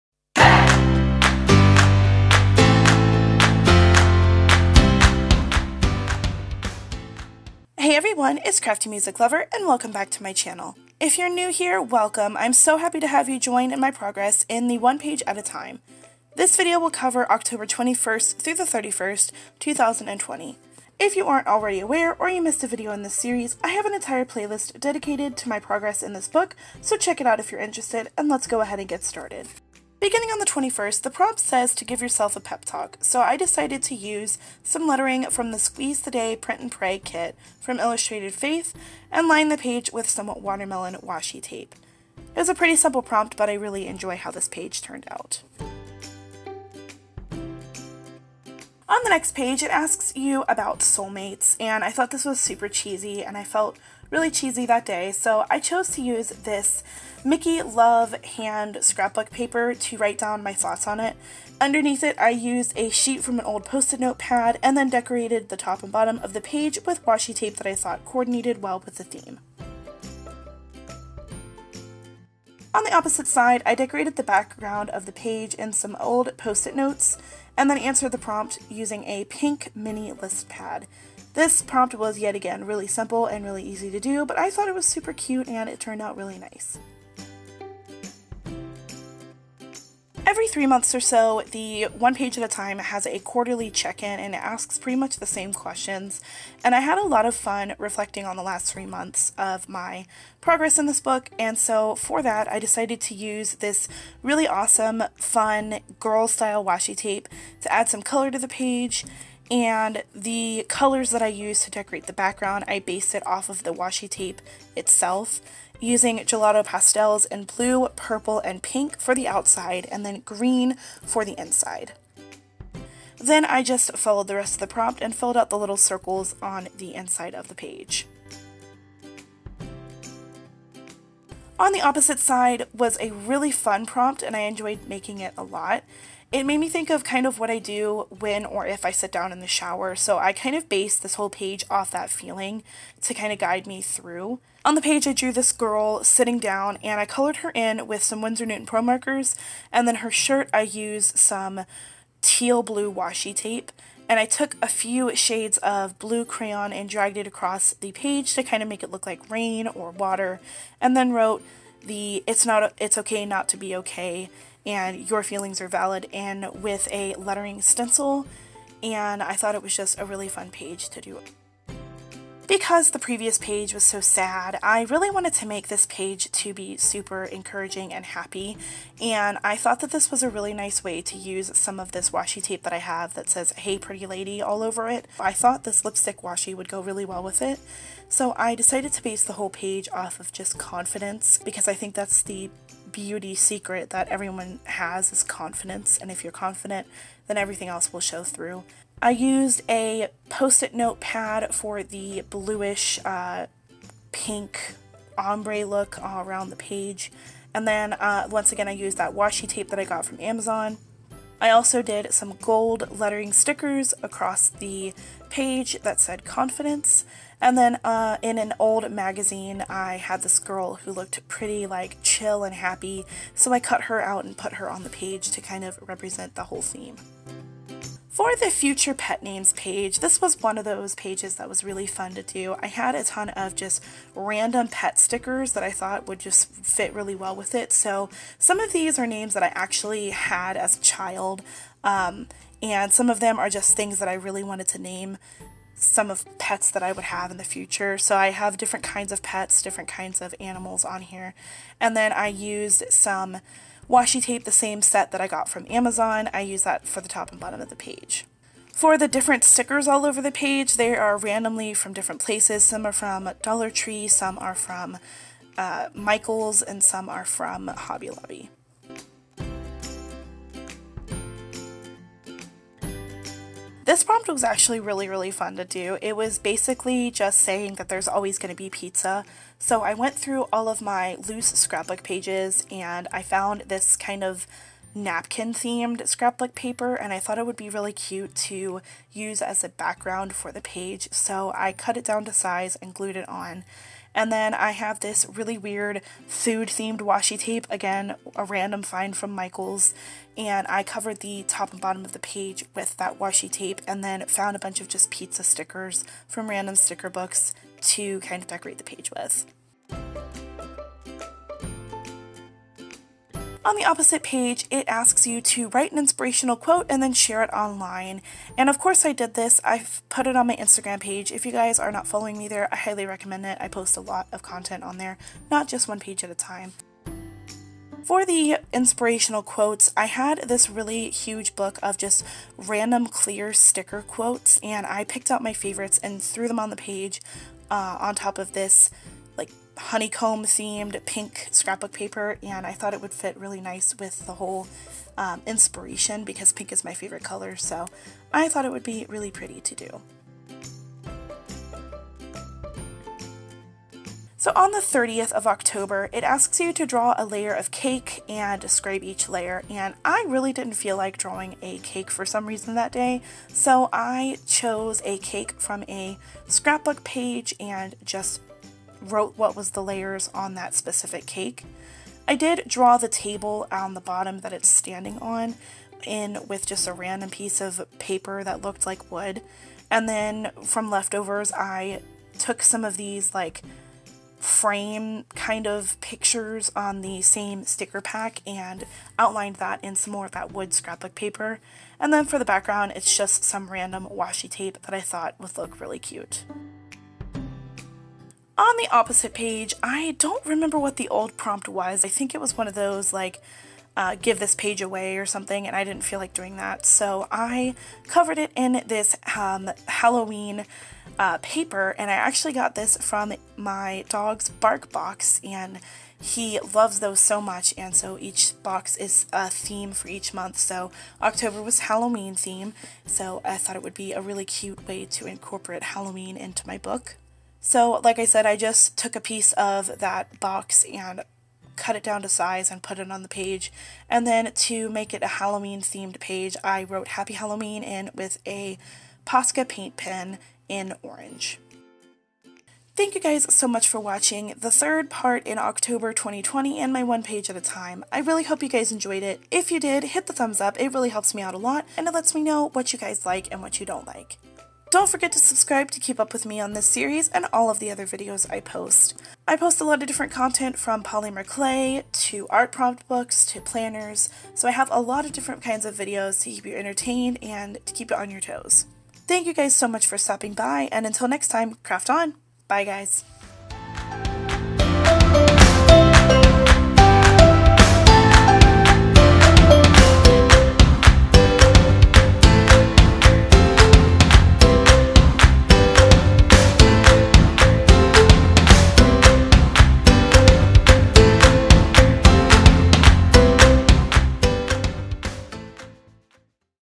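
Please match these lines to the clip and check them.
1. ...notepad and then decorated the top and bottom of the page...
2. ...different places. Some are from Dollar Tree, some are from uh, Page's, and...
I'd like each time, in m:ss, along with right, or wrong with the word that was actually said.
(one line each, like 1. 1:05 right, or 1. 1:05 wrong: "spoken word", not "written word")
1. 1:03 right
2. 4:21 wrong: "Michael", not "Page".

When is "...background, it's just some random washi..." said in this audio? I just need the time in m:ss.
6:32.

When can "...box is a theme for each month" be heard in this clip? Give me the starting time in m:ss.
6:58.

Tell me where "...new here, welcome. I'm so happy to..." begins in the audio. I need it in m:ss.
0:11.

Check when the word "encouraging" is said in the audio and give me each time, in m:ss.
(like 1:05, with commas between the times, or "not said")
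2:57.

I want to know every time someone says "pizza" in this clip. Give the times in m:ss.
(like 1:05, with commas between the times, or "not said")
4:38, 5:05.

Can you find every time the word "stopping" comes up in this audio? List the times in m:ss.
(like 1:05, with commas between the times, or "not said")
7:50.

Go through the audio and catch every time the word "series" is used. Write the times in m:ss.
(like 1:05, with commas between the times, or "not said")
0:23, 7:36.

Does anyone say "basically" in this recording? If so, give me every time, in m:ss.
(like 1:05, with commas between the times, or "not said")
4:36.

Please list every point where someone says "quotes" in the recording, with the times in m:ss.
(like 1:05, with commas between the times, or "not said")
5:16, 5:29, 5:34.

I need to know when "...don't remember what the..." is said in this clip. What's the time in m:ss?
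6:40.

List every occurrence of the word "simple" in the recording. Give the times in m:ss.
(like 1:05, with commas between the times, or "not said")
0:42, 1:22.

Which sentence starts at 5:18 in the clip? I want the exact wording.
And of course, I did this.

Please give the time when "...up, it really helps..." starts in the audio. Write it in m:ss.
7:30.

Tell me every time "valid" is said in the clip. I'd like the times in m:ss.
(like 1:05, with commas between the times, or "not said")
2:45.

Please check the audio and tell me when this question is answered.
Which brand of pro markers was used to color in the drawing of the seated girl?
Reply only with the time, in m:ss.
2:28.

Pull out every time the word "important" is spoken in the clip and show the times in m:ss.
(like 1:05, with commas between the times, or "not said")
not said.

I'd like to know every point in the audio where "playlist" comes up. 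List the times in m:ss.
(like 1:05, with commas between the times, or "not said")
0:24.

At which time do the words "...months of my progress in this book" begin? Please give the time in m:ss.
1:38.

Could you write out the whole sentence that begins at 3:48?
For the future pet names page, this was one of those pages that was really fun to do.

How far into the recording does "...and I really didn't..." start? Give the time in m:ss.
5:59.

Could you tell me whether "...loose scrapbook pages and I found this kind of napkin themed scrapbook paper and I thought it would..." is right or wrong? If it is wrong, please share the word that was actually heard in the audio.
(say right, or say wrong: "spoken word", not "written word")
right.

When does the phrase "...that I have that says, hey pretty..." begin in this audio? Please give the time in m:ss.
3:02.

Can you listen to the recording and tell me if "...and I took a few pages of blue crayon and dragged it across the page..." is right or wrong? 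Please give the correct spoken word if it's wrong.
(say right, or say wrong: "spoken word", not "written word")
wrong: "shades", not "pages".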